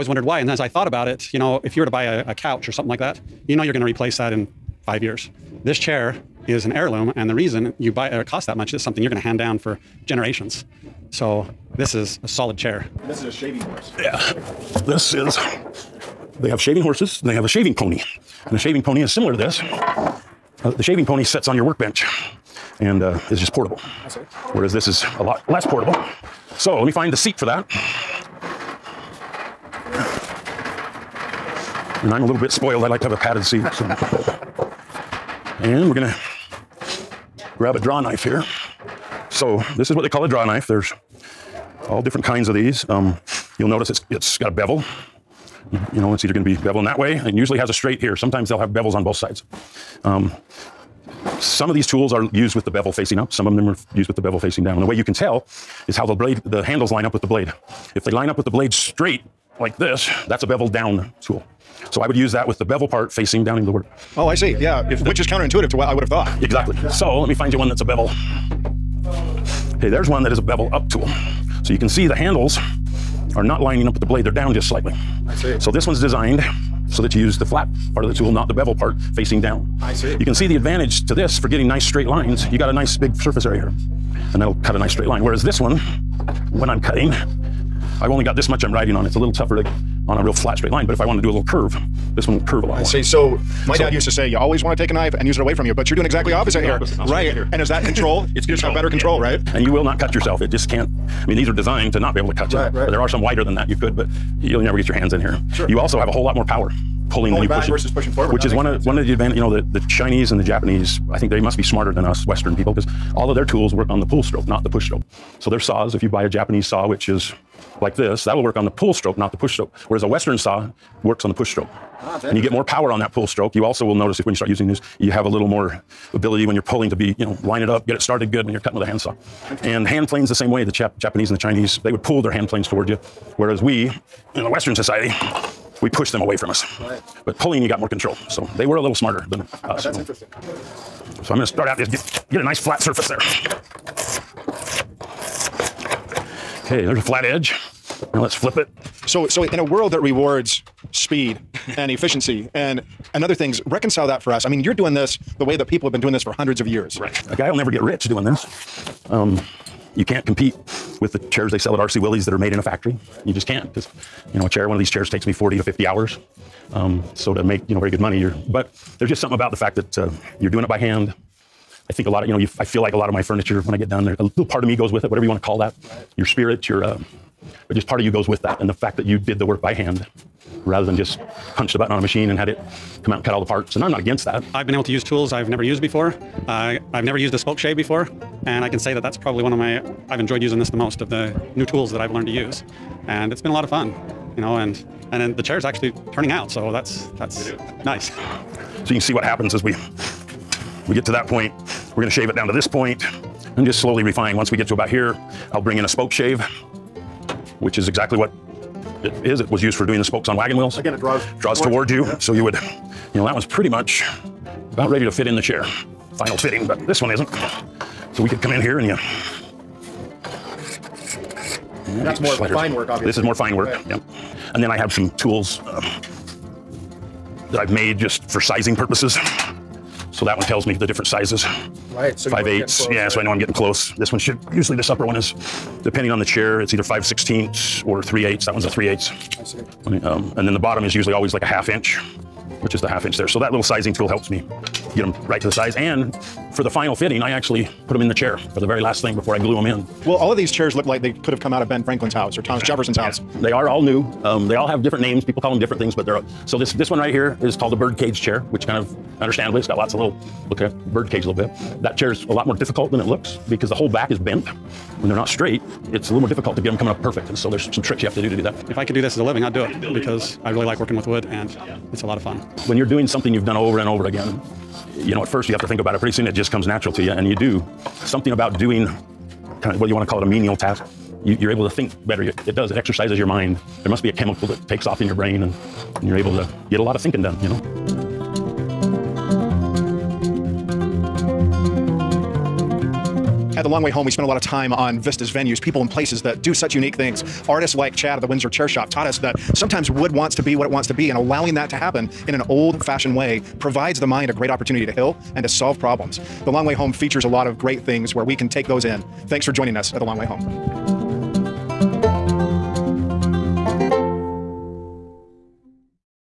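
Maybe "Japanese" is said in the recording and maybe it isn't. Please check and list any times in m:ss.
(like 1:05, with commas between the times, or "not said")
1:50, 1:56, 2:10.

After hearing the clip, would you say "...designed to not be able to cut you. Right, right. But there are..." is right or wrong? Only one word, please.
right.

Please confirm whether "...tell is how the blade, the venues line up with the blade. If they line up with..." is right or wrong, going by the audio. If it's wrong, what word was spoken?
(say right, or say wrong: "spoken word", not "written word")
wrong: "handles", not "venues".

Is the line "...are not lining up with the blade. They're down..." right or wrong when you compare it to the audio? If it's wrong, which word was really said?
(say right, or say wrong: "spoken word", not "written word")
right.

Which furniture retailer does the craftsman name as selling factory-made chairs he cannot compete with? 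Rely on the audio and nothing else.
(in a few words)
RC Willey's.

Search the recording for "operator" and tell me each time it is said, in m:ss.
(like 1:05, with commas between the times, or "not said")
not said.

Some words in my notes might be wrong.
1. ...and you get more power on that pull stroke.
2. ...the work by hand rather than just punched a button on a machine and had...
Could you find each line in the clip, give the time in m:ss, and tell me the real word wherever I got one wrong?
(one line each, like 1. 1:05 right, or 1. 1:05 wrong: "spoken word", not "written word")
1. 2:02 right
2. 2:59 right.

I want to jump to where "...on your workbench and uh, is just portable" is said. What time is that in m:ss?
0:21.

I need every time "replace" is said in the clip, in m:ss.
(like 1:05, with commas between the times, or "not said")
0:03.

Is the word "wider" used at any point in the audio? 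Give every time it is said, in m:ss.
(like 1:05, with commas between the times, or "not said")
1:43.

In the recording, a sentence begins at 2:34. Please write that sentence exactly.
I mean, you're doing this the way that people have been doing this for hundreds of years.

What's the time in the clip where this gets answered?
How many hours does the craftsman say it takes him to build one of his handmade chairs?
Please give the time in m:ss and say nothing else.
2:45.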